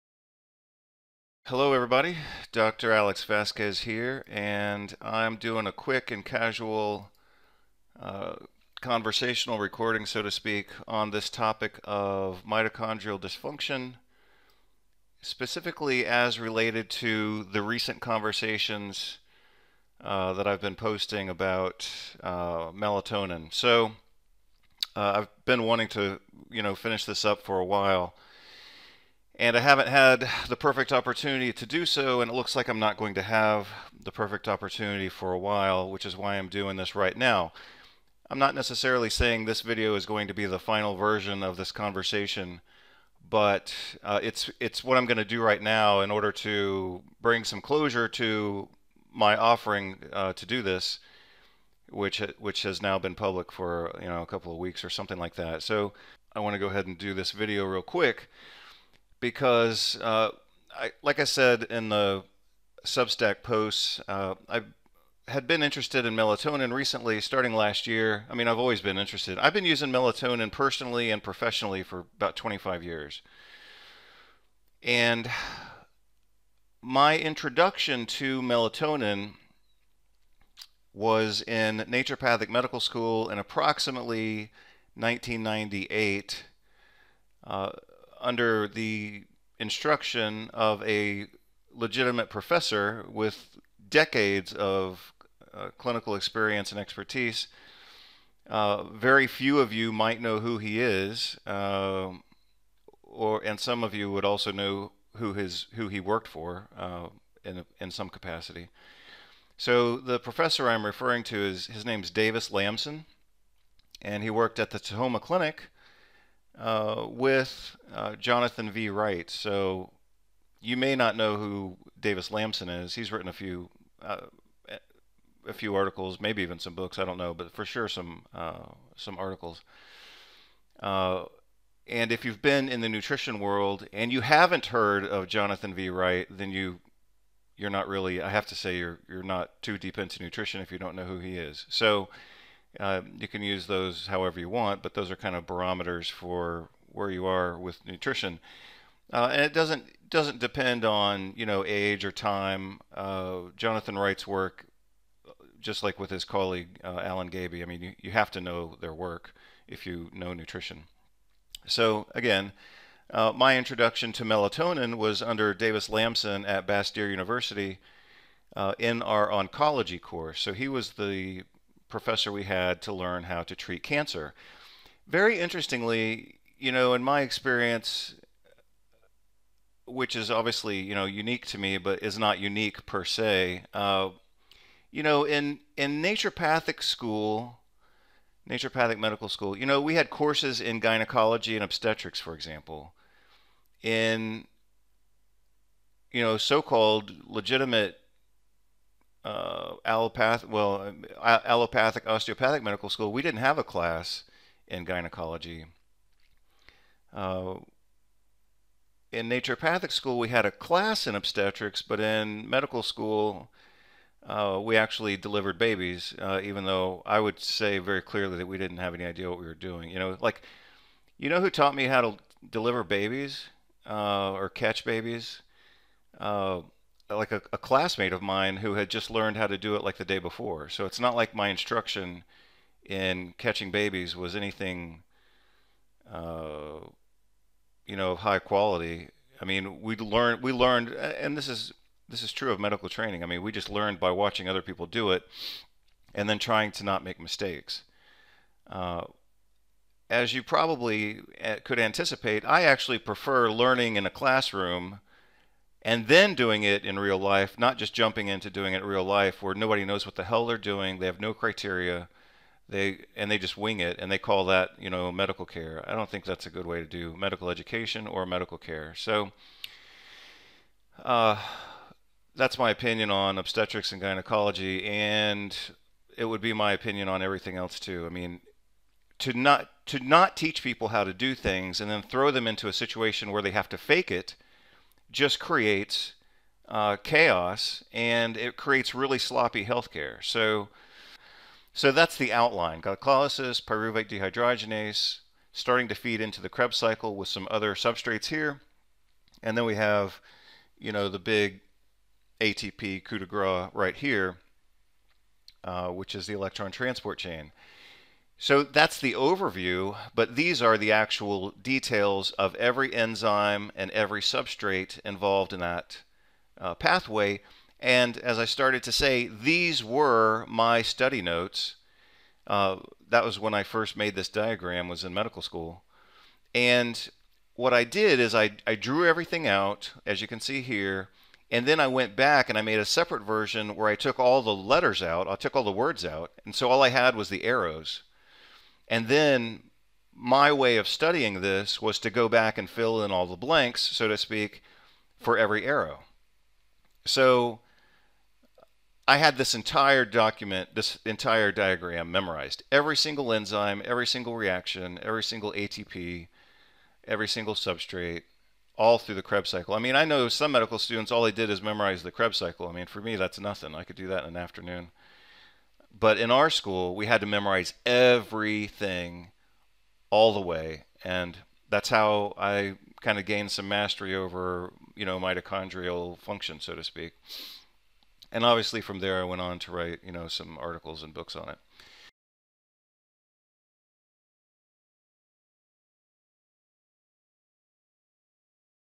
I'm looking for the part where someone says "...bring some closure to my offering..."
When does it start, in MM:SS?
00:47.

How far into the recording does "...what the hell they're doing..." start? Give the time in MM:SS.
04:20.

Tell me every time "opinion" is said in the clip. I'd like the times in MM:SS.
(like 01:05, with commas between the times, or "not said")
04:32, 04:36.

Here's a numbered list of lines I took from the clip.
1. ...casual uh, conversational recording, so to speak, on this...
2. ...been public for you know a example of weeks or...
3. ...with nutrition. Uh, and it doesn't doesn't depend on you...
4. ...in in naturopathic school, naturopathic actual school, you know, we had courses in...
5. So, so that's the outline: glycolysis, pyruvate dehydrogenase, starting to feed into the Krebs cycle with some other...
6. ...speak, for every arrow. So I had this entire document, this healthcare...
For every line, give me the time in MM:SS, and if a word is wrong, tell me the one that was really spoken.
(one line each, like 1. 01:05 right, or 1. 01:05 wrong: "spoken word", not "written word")
1. 00:06 right
2. 00:52 wrong: "couple", not "example"
3. 02:27 right
4. 03:05 wrong: "medical", not "actual"
5. 04:50 right
6. 05:44 wrong: "entire", not "healthcare".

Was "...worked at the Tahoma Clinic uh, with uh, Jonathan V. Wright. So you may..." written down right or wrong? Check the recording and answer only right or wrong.
right.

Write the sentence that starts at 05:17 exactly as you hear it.
And as I started to say, these were my study notes.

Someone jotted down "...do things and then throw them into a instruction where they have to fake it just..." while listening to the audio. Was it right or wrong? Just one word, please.
wrong.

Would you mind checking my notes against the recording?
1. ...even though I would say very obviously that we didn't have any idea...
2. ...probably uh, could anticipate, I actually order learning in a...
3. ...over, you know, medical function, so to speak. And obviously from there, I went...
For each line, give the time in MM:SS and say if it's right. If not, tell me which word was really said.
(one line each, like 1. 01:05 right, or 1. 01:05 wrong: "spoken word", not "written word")
1. 03:36 wrong: "clearly", not "obviously"
2. 04:10 wrong: "prefer", not "order"
3. 06:14 wrong: "mitochondrial", not "medical".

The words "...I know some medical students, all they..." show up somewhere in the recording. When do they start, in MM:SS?
05:59.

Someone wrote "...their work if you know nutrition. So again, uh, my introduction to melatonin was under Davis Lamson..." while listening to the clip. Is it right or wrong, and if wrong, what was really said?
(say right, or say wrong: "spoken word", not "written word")
right.